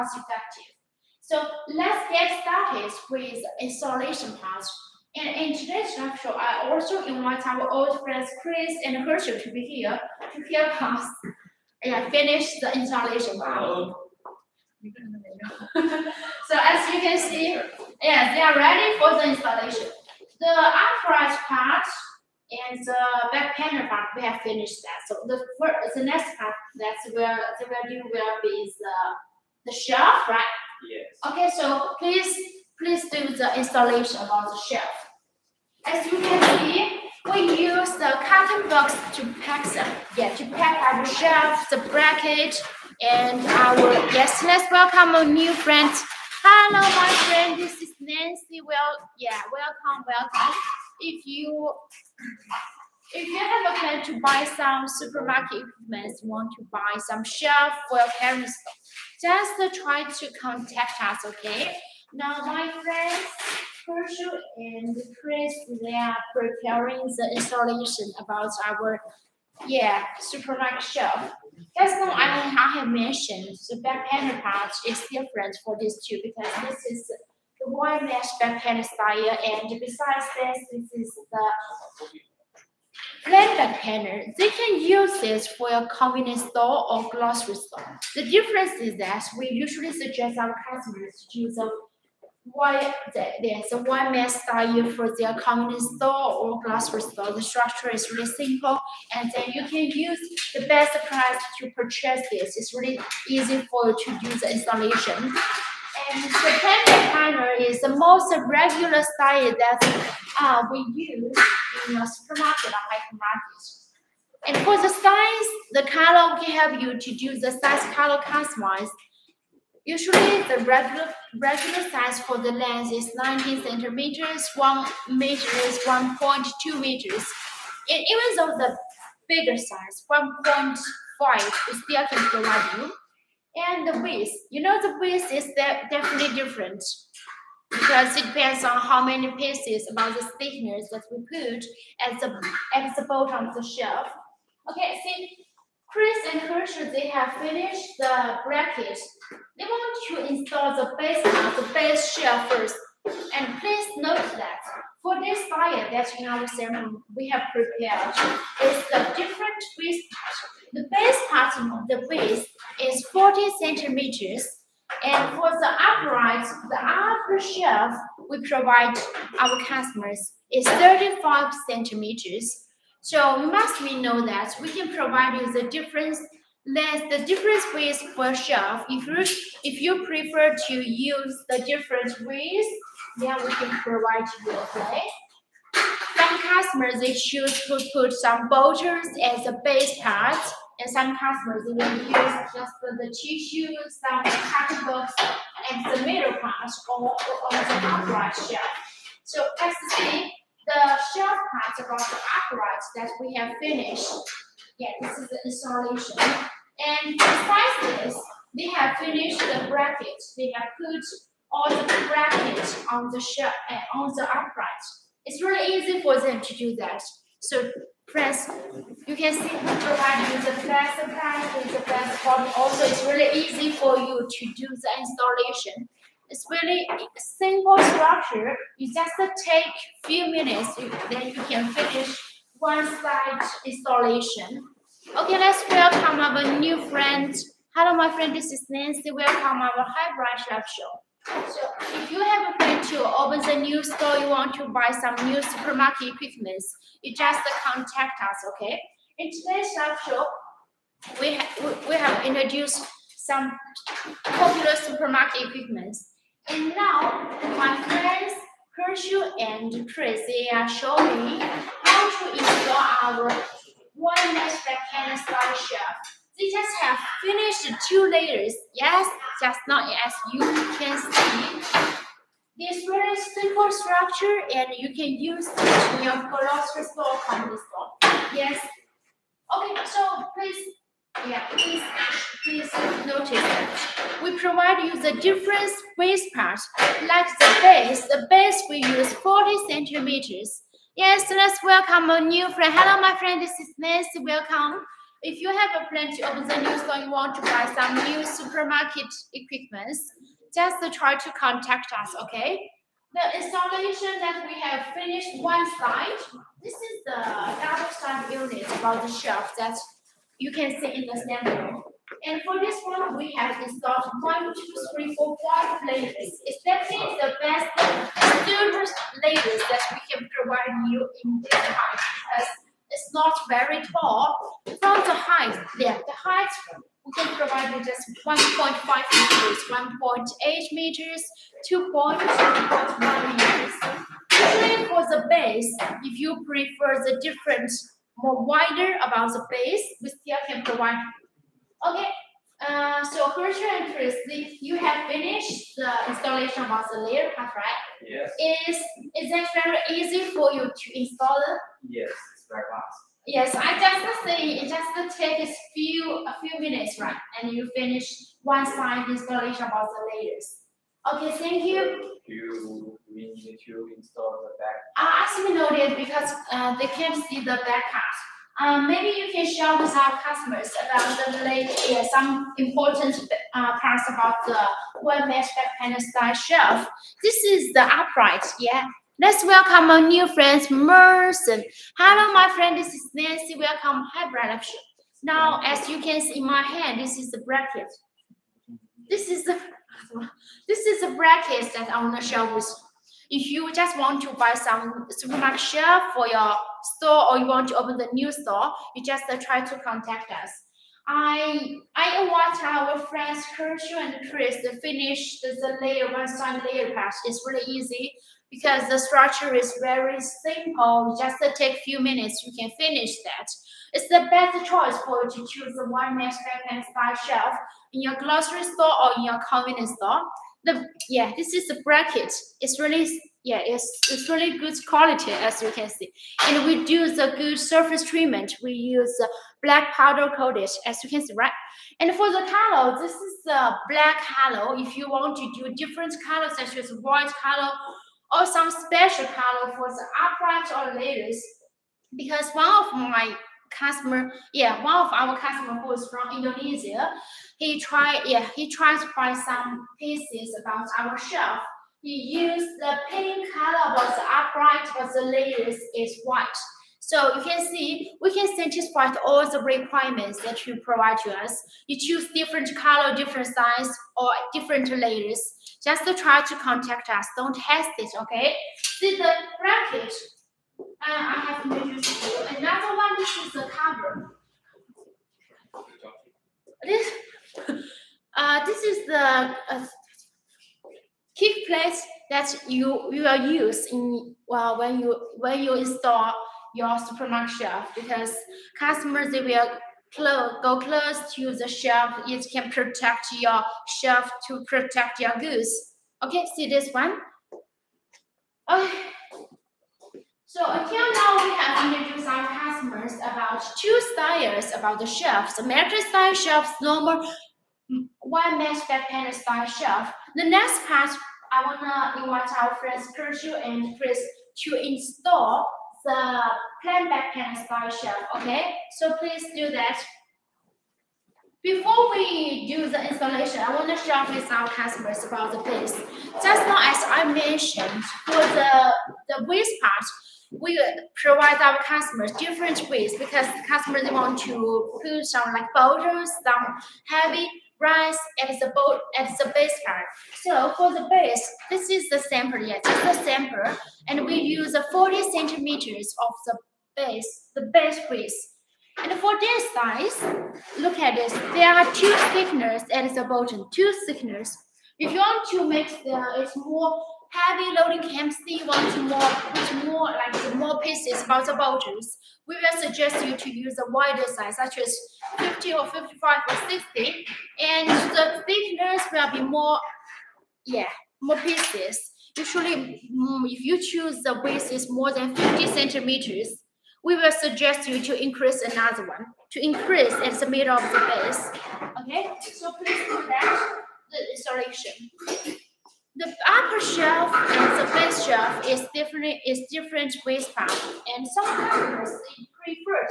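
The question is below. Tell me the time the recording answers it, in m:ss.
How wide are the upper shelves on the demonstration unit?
2:50.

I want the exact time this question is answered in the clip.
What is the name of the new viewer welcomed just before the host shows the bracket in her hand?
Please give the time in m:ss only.
6:20.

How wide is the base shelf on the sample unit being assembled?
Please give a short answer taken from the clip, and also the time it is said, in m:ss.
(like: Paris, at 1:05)
40 centimeters, at 2:40.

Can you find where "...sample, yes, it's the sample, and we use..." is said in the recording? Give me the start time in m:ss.
9:02.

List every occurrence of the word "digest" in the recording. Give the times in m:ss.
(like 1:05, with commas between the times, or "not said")
not said.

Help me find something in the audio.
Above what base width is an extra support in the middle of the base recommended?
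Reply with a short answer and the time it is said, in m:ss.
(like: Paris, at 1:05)
50 centimeters, at 9:34.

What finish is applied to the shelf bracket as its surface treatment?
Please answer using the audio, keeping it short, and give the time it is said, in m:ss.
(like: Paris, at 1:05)
Black powder coated, at 7:09.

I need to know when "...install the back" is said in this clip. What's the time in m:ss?
6:03.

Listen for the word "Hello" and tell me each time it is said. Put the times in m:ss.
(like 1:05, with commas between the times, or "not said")
0:46, 3:57, 4:52, 6:21.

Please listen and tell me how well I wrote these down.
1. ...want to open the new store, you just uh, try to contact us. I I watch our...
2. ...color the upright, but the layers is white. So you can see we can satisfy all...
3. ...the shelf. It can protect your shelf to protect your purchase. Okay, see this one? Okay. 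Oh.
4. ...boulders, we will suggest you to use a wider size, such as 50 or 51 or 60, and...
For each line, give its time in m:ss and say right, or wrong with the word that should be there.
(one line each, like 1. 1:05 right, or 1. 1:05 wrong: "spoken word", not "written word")
1. 6:37 right
2. 7:33 right
3. 8:11 wrong: "goose", not "purchase"
4. 9:21 wrong: "55", not "51".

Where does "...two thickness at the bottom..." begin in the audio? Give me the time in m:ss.
9:11.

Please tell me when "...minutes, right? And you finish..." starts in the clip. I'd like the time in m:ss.
5:56.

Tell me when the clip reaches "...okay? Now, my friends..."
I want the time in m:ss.
1:01.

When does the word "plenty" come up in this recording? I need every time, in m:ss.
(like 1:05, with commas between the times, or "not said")
4:55.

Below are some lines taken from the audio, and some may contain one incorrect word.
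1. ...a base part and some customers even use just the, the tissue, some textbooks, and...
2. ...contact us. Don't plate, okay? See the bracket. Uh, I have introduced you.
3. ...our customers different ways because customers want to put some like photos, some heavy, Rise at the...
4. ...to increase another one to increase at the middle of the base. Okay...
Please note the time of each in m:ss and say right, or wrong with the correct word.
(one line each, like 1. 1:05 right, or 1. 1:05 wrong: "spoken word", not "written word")
1. 3:09 right
2. 7:46 wrong: "hesitate", not "plate"
3. 8:51 right
4. 9:38 right.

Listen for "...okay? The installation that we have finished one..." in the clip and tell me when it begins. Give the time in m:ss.
5:02.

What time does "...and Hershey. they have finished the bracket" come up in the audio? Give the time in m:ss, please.
2:26.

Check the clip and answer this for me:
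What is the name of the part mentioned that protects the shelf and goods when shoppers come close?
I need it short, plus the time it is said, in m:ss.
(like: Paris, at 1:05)
Kick plate, at 8:01.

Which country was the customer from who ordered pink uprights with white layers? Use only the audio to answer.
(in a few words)
Indonesia.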